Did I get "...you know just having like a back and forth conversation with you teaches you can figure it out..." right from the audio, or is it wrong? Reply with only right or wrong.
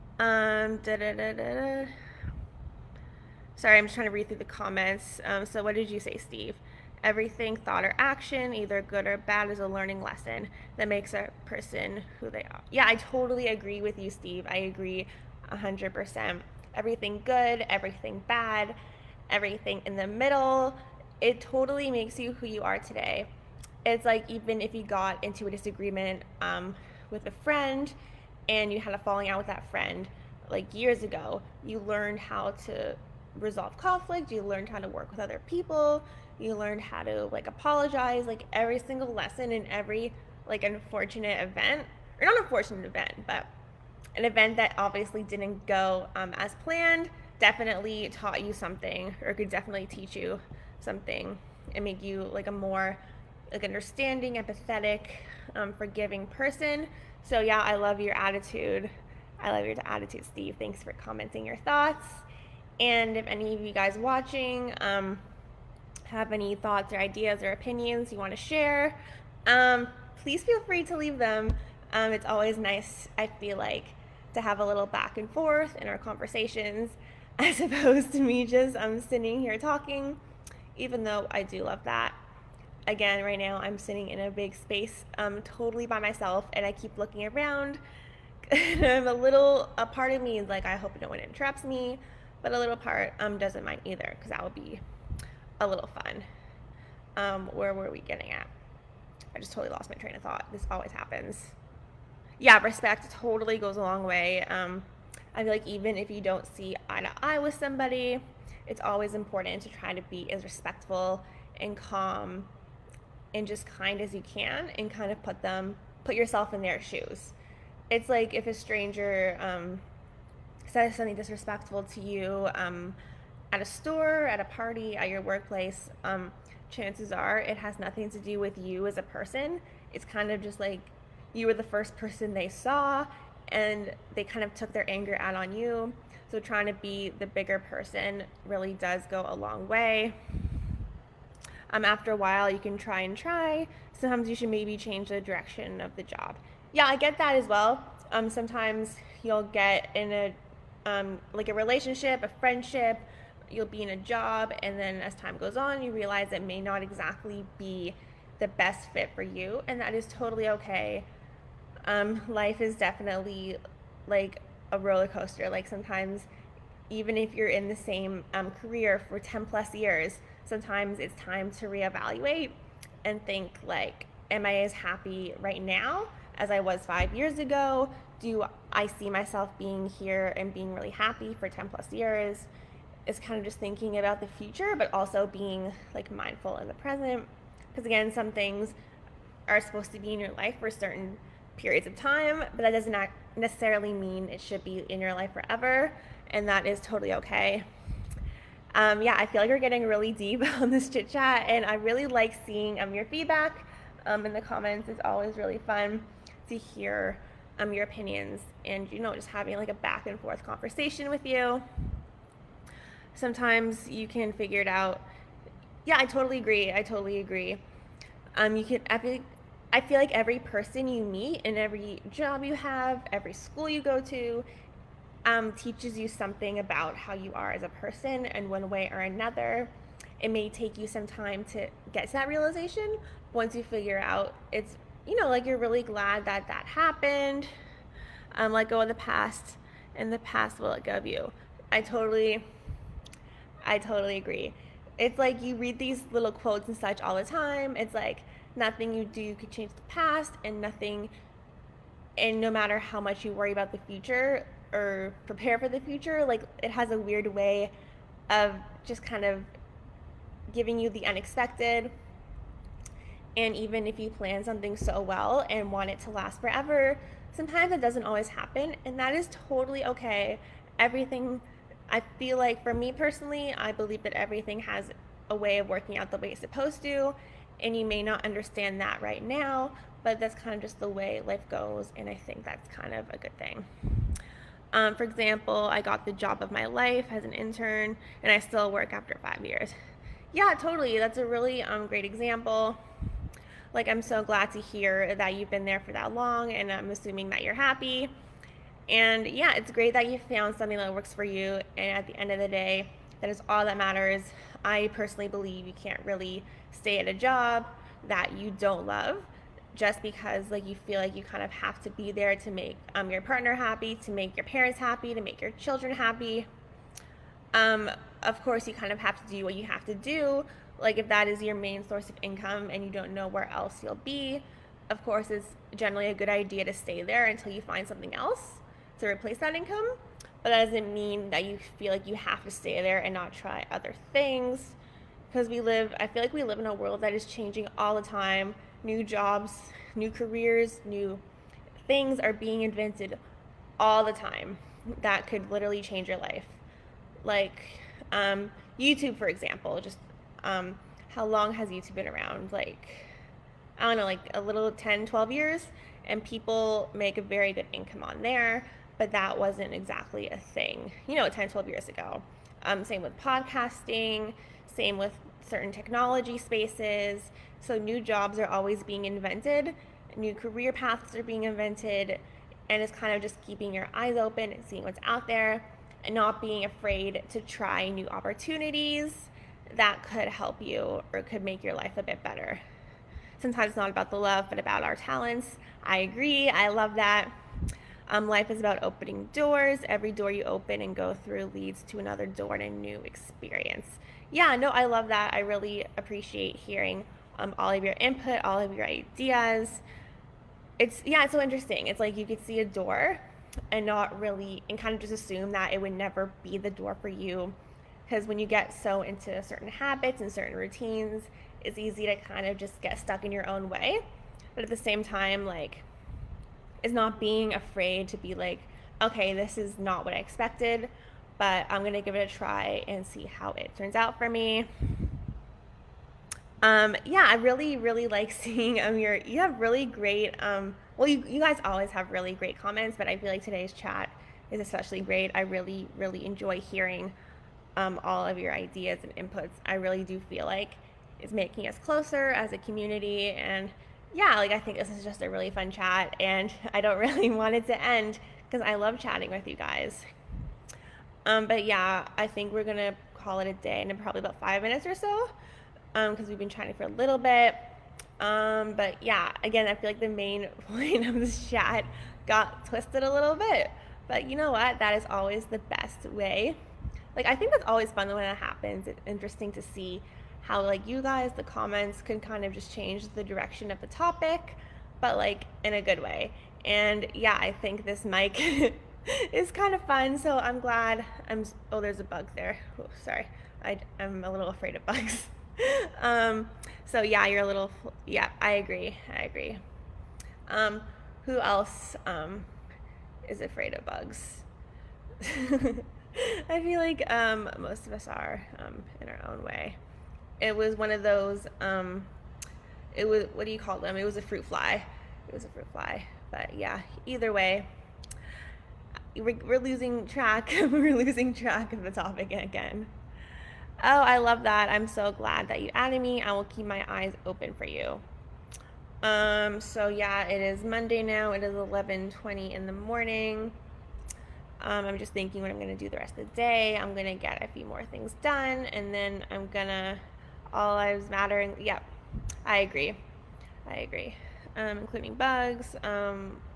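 wrong.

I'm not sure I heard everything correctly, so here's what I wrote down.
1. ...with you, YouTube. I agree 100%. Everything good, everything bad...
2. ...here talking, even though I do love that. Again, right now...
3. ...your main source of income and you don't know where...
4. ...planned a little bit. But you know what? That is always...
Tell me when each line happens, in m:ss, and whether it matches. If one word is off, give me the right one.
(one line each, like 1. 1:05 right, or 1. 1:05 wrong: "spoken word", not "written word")
1. 0:13 wrong: "Steve", not "YouTube"
2. 1:19 right
3. 5:21 right
4. 7:42 wrong: "twisted", not "planned".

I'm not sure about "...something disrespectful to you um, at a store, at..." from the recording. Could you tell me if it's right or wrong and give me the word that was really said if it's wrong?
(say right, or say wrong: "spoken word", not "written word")
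right.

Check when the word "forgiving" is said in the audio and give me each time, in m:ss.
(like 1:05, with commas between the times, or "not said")
0:55.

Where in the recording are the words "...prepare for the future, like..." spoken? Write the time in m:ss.
4:15.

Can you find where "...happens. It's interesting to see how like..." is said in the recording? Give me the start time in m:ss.
7:48.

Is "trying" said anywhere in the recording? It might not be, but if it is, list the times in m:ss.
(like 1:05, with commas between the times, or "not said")
0:03, 2:16.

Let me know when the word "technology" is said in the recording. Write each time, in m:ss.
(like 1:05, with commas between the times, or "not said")
6:05.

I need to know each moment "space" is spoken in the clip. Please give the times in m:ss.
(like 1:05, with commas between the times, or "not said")
1:24, 6:06.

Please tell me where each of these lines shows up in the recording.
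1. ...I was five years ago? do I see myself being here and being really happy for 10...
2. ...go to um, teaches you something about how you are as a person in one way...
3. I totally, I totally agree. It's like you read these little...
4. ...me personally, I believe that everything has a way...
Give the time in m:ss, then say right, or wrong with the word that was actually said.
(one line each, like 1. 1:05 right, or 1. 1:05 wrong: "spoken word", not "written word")
1. 2:56 right
2. 3:43 right
3. 4:01 right
4. 4:32 right.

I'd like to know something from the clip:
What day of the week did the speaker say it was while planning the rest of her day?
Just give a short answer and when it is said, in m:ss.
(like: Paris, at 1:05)
Monday, at 8:40.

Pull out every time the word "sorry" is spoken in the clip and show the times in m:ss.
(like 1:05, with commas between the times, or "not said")
0:03, 8:03.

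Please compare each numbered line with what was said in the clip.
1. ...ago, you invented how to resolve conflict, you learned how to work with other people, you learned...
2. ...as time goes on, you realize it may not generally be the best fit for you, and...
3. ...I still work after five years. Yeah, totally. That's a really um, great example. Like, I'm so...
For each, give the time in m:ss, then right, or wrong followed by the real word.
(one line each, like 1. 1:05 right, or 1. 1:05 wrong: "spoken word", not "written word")
1. 0:31 wrong: "learned", not "invented"
2. 2:35 wrong: "exactly", not "generally"
3. 4:48 right.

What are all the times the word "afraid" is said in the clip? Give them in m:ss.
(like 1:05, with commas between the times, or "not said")
6:16, 6:57, 8:04, 8:13.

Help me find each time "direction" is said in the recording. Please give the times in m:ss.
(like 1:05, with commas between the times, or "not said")
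2:25, 7:53.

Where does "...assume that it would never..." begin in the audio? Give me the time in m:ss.
6:45.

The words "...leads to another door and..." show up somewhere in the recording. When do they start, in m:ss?
6:31.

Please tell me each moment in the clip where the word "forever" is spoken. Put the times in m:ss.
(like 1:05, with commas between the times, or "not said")
3:15, 4:26.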